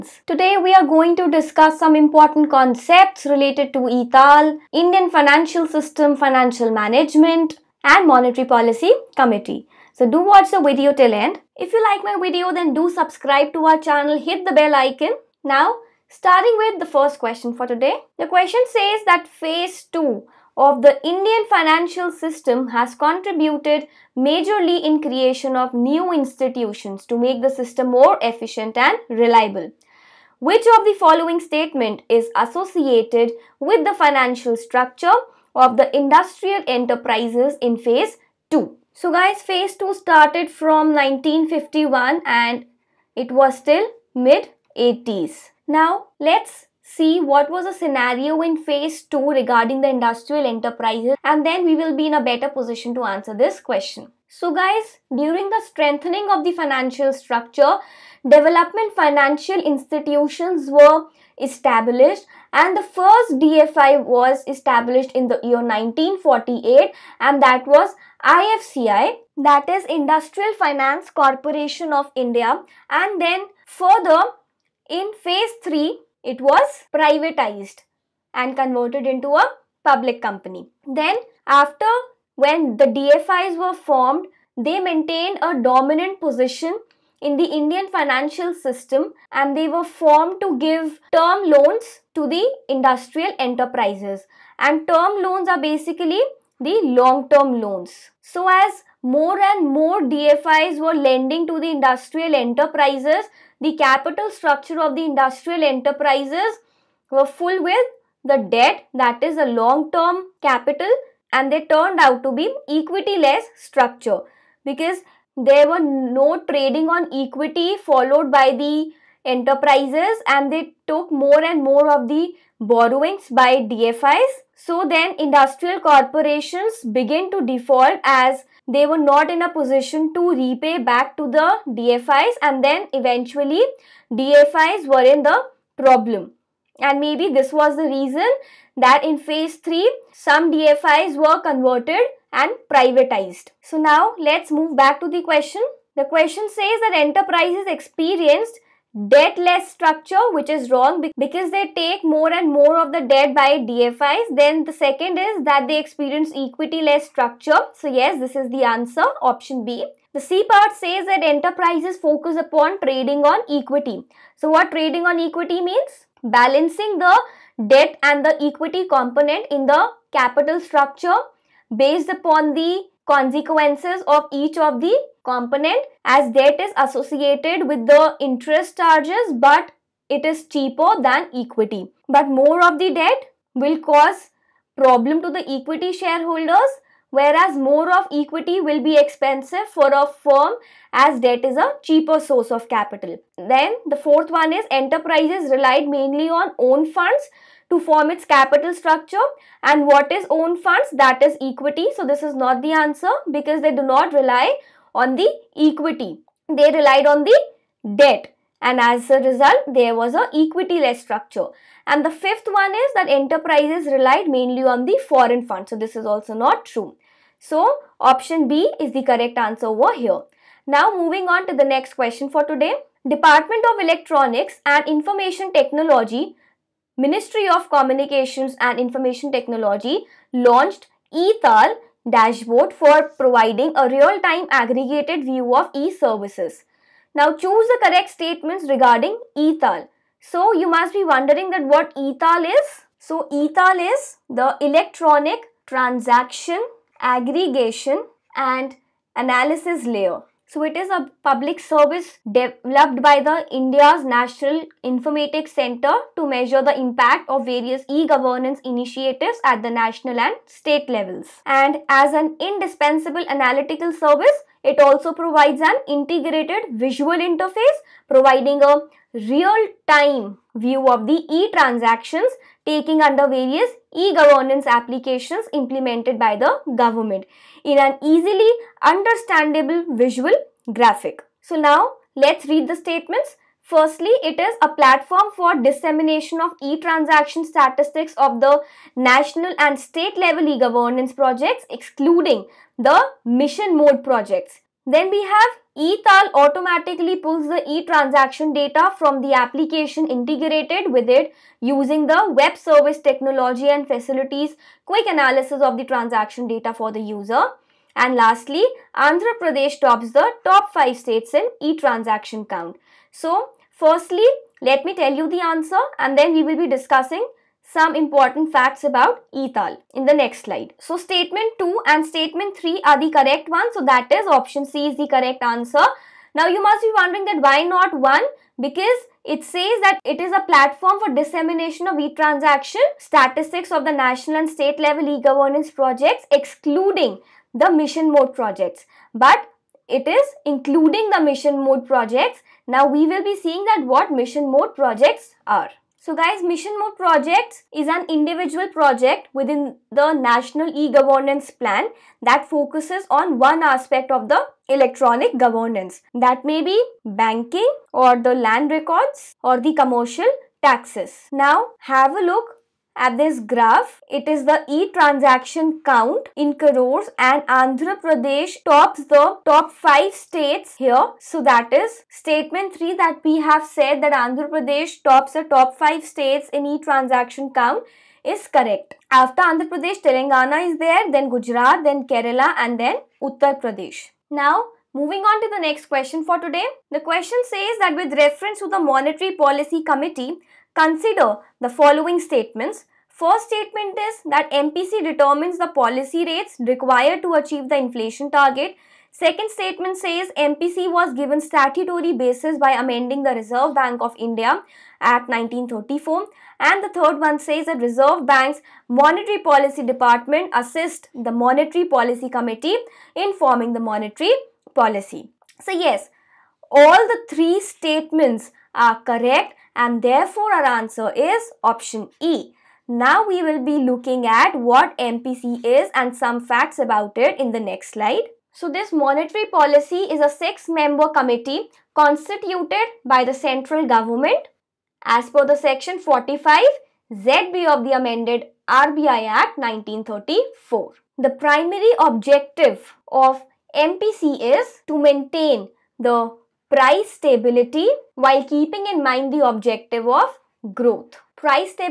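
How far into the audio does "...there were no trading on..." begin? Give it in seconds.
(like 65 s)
115 s.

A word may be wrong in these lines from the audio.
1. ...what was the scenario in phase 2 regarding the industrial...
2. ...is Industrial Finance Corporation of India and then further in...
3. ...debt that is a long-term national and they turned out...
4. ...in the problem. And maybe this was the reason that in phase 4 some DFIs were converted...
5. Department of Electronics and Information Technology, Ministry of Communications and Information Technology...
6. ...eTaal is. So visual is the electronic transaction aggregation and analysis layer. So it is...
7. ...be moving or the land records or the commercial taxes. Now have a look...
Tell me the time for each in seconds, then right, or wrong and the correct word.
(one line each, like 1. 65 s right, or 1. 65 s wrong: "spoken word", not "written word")
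1. 47 s right
2. 69 s right
3. 108 s wrong: "capital", not "national"
4. 135 s wrong: "3", not "4"
5. 223 s right
6. 241 s wrong: "eTaal", not "visual"
7. 356 s wrong: "banking", not "moving".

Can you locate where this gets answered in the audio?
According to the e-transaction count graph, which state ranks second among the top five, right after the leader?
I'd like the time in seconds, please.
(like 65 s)
380 s.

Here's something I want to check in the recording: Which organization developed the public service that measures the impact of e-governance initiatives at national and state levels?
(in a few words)
National Informatics Center.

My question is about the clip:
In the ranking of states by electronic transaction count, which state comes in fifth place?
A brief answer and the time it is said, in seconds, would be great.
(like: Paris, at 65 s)
Uttar Pradesh, at 383 s.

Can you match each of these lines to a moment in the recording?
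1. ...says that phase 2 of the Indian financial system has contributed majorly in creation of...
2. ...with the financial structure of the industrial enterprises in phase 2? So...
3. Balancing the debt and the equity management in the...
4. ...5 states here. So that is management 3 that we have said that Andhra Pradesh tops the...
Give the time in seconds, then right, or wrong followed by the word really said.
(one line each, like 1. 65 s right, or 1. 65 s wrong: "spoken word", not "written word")
1. 18 s right
2. 33 s right
3. 166 s wrong: "component", not "management"
4. 369 s wrong: "statement", not "management".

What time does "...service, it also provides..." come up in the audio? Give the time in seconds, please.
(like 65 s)
263 s.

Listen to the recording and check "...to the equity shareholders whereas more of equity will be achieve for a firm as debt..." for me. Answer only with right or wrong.
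wrong.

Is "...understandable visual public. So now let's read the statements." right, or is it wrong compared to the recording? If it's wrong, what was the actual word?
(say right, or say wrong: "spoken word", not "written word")
wrong: "graphic", not "public".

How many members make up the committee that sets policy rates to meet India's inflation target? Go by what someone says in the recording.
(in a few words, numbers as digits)
6.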